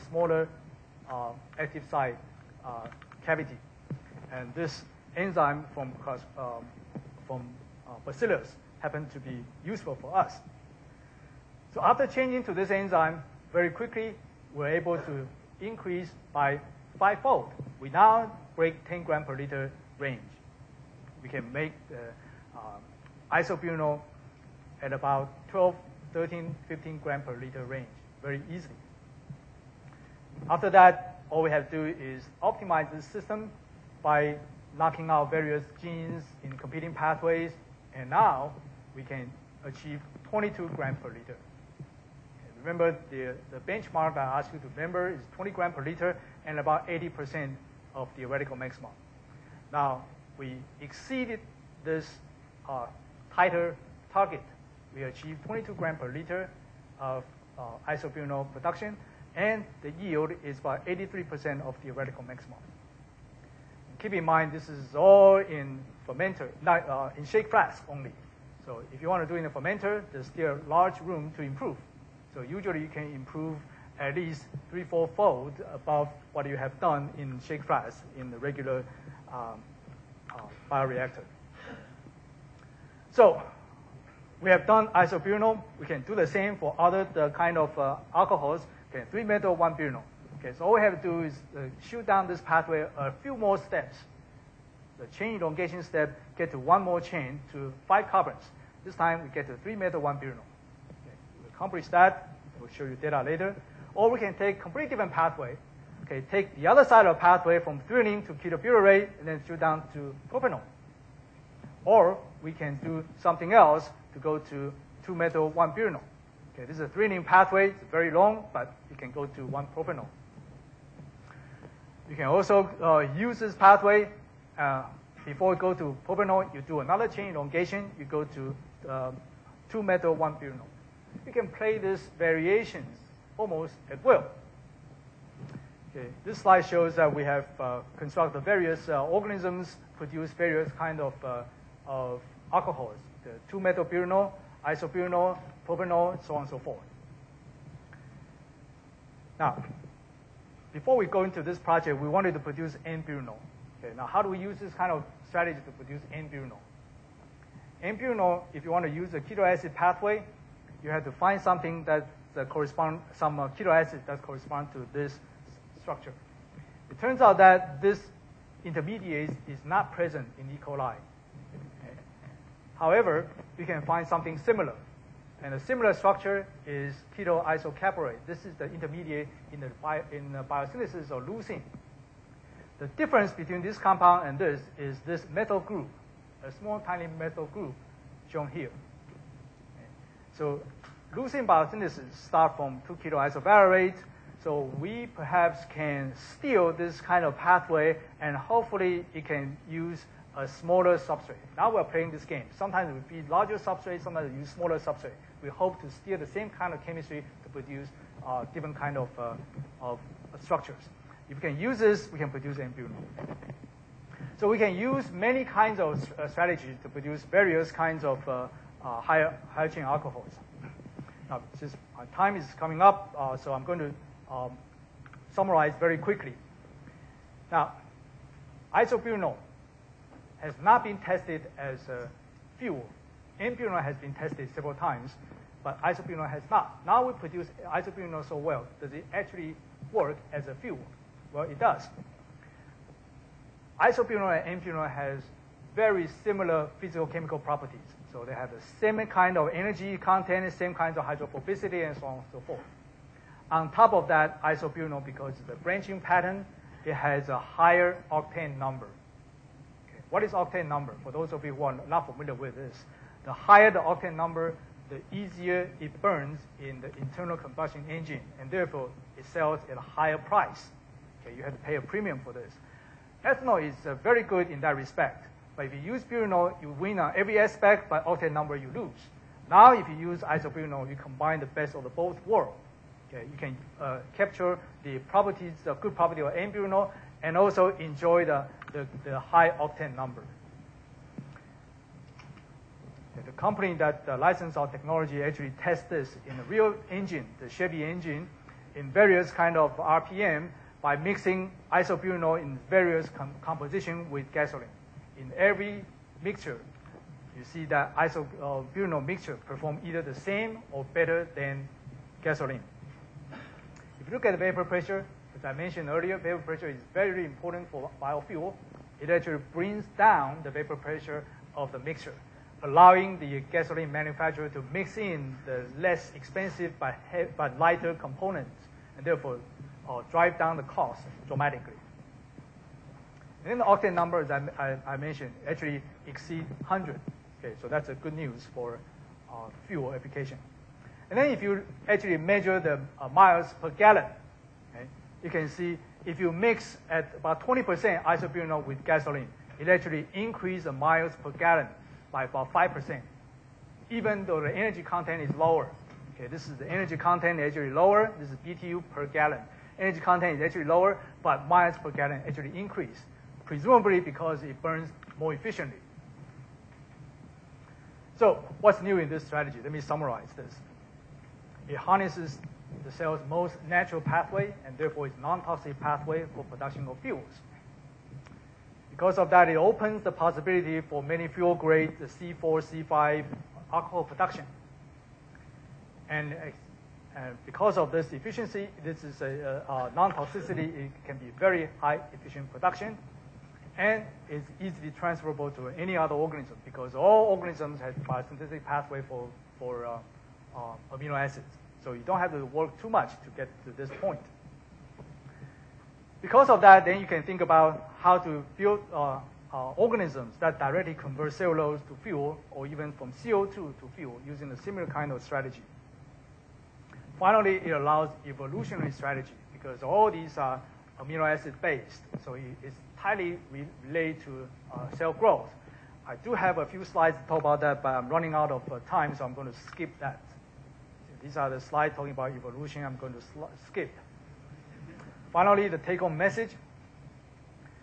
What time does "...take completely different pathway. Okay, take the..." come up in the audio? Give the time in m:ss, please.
1:44.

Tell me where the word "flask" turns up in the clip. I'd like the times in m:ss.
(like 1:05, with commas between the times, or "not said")
1:07, 1:17.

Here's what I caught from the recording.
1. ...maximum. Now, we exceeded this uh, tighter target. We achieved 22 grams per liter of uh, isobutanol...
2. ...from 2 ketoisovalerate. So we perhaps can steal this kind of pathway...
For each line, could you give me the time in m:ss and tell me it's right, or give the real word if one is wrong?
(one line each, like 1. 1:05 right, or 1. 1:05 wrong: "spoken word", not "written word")
1. 0:48 right
2. 3:12 right.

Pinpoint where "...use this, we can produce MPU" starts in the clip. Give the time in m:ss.
3:31.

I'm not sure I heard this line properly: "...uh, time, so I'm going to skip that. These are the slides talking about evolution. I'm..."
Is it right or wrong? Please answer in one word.
right.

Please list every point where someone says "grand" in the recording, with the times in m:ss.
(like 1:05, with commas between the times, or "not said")
not said.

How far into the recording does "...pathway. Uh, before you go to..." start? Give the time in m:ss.
2:03.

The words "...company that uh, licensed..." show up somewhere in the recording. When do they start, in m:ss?
4:53.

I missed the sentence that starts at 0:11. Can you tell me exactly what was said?
So after changing to this enzyme, very quickly, we're able to increase by fivefold.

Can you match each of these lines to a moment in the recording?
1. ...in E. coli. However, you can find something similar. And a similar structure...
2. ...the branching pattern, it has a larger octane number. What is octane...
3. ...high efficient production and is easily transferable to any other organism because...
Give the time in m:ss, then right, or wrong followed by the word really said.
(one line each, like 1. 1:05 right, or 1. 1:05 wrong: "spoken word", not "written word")
1. 2:50 right
2. 4:15 wrong: "higher", not "larger"
3. 6:31 right.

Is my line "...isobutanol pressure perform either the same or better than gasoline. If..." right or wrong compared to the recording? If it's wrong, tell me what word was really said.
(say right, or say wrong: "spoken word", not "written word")
wrong: "mixture", not "pressure".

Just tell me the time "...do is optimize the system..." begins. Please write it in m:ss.
0:31.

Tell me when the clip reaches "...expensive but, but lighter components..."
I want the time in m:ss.
5:26.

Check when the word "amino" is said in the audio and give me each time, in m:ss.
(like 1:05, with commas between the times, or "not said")
6:40, 7:01.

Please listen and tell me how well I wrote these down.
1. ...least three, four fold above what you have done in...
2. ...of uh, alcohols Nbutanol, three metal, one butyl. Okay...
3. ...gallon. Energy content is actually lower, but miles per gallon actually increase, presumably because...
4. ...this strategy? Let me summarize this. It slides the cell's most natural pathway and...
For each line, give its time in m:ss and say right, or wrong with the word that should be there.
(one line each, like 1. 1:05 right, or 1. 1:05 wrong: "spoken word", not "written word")
1. 1:14 right
2. 1:27 wrong: "Okay", not "Nbutanol"
3. 5:59 right
4. 6:09 wrong: "harnesses", not "slides".